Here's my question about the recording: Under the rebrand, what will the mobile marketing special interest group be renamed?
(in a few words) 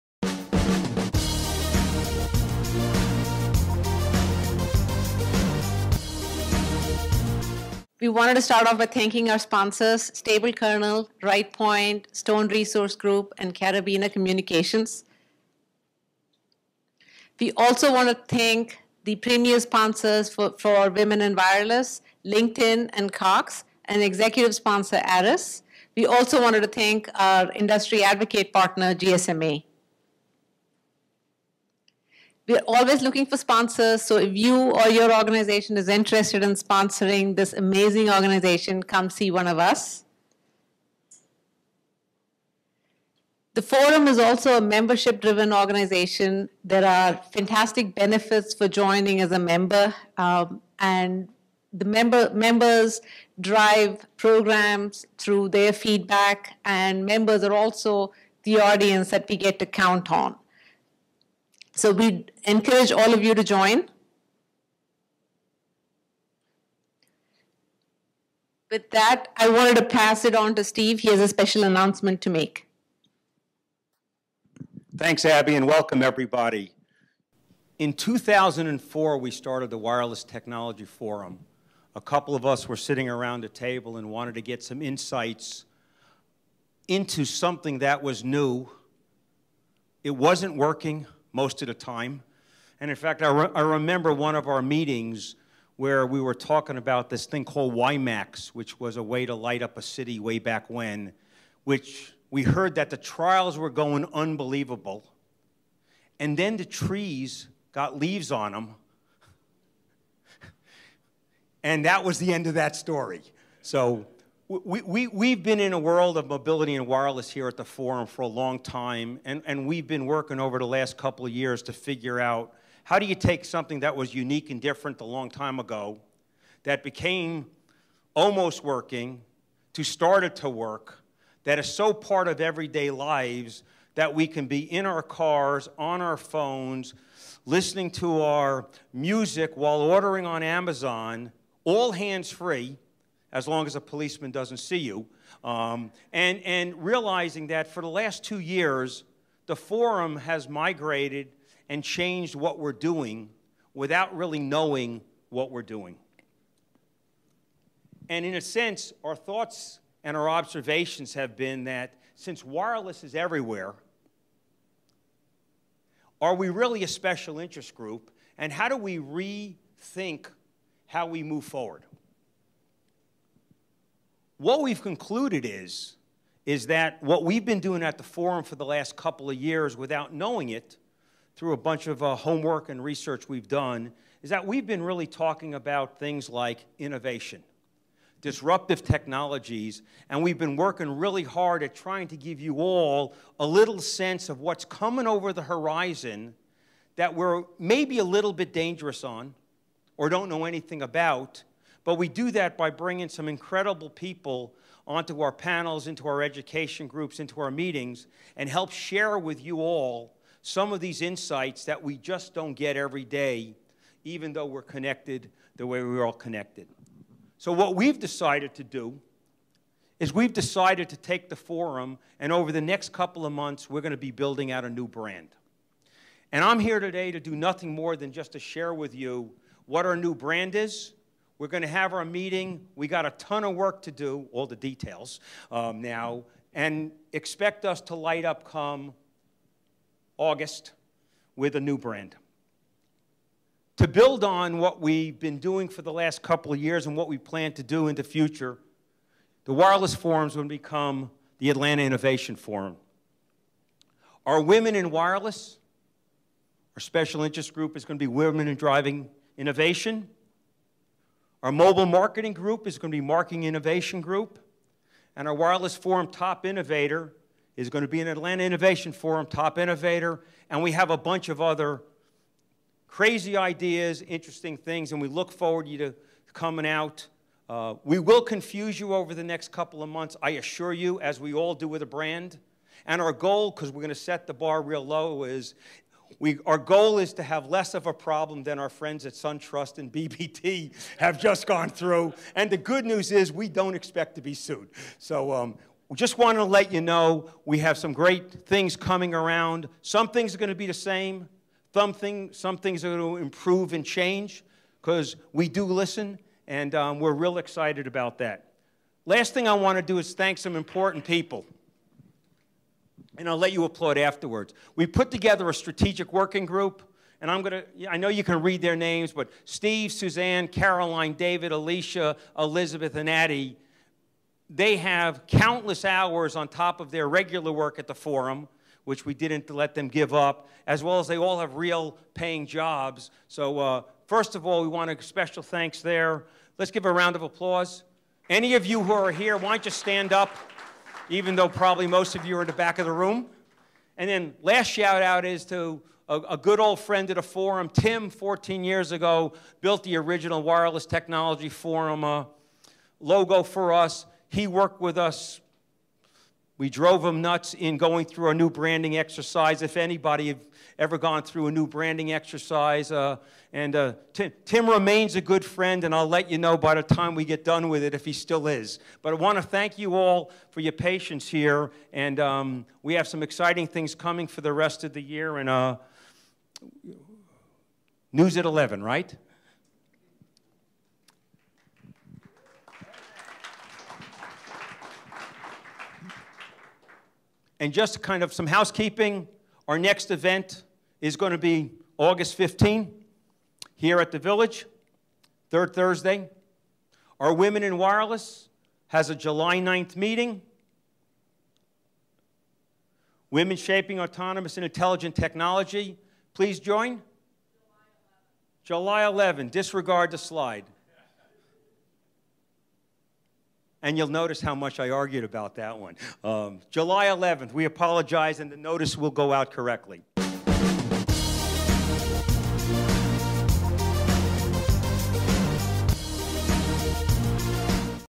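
Marketing Innovation Group.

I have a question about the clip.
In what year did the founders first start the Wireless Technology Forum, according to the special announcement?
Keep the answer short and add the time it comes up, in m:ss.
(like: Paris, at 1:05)
2004, at 1:17.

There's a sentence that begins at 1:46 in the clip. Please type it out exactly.
And then the trees got leaves on them.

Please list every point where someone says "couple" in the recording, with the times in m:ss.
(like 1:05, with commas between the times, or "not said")
1:22, 2:00, 2:58, 3:42, 4:06, 4:39.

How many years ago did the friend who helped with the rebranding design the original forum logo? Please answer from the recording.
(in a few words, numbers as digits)
14.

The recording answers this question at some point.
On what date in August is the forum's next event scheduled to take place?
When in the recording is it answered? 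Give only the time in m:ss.
6:31.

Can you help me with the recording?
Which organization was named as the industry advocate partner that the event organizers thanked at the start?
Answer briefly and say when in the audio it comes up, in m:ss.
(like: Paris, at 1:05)
GSMA, at 0:28.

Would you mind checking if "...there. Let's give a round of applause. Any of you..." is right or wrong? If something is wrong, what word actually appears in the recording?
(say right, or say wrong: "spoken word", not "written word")
right.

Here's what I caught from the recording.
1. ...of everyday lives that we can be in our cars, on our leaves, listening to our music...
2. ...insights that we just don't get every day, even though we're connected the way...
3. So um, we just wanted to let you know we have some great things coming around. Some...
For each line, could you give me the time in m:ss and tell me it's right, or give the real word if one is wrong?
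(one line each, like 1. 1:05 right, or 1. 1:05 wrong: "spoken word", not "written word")
1. 2:12 wrong: "phones", not "leaves"
2. 3:31 right
3. 4:54 right.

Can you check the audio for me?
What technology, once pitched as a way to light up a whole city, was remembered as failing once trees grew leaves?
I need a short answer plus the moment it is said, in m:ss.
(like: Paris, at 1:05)
WiMAX, at 1:37.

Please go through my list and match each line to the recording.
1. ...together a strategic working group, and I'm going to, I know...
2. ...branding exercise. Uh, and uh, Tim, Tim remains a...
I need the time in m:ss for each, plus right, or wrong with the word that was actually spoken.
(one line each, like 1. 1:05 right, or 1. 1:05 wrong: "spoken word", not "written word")
1. 5:15 right
2. 6:01 right.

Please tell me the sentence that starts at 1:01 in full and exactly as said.
So we encourage all of you to join.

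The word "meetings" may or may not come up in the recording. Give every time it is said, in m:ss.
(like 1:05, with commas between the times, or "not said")
1:34, 3:27, 3:52, 6:39.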